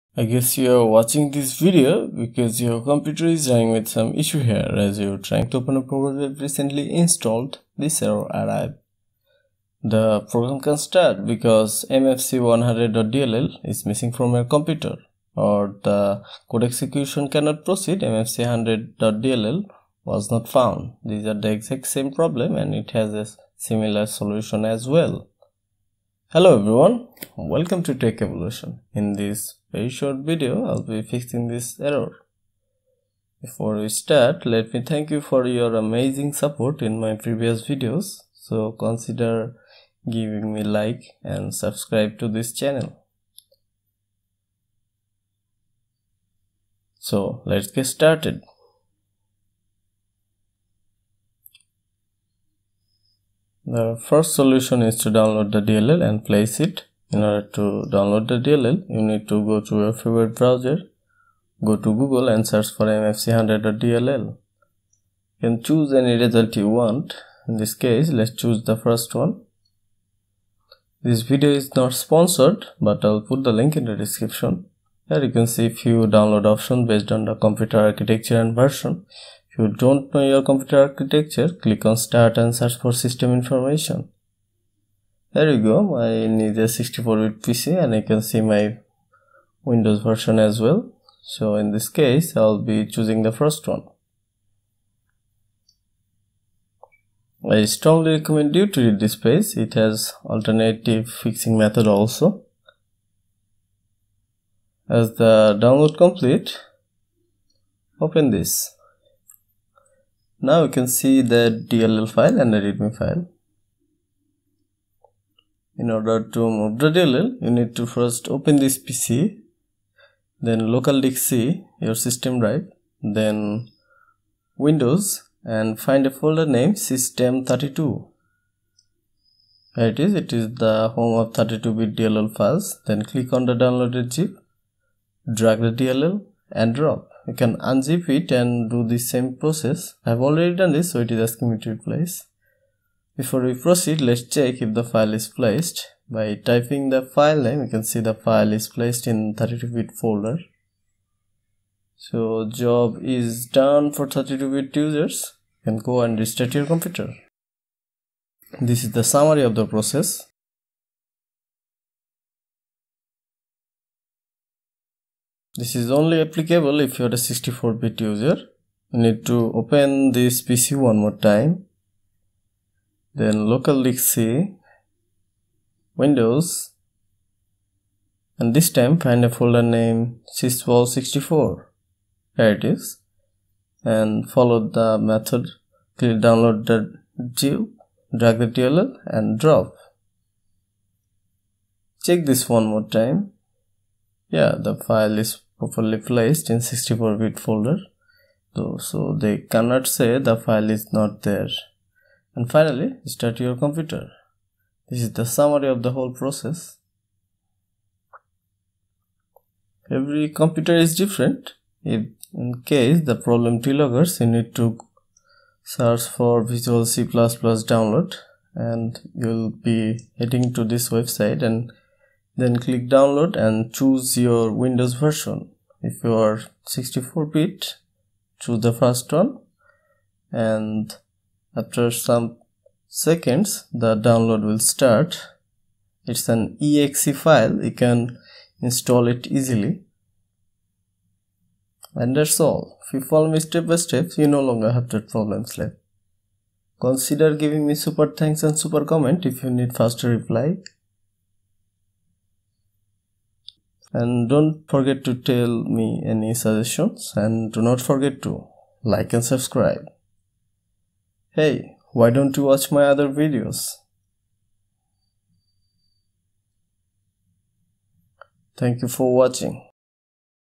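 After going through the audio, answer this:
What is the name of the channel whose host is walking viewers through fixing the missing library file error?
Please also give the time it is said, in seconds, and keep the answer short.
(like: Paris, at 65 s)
Tech Evolution, at 27 s.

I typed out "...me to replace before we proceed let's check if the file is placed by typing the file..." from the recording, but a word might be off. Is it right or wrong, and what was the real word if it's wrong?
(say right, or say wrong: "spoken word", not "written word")
right.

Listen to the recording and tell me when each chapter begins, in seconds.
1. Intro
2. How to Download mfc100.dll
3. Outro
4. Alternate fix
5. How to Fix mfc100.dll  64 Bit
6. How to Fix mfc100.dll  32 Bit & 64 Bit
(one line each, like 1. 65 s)
1. 22 s
2. 44 s
3. 241 s
4. 208 s
5. 163 s
6. 113 s.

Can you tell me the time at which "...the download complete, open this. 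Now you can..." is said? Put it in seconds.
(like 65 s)
105 s.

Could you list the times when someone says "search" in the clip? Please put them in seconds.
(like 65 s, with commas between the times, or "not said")
62 s, 82 s, 215 s.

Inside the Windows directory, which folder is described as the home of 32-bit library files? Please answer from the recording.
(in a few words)
system32.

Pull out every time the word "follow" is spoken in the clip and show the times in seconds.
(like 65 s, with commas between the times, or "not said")
184 s, 243 s.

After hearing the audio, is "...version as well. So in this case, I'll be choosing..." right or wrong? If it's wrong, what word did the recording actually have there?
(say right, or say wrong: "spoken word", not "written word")
right.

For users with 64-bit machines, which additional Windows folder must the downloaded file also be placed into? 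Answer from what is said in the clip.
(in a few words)
SysWOW64.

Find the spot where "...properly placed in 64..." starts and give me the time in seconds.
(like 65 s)
195 s.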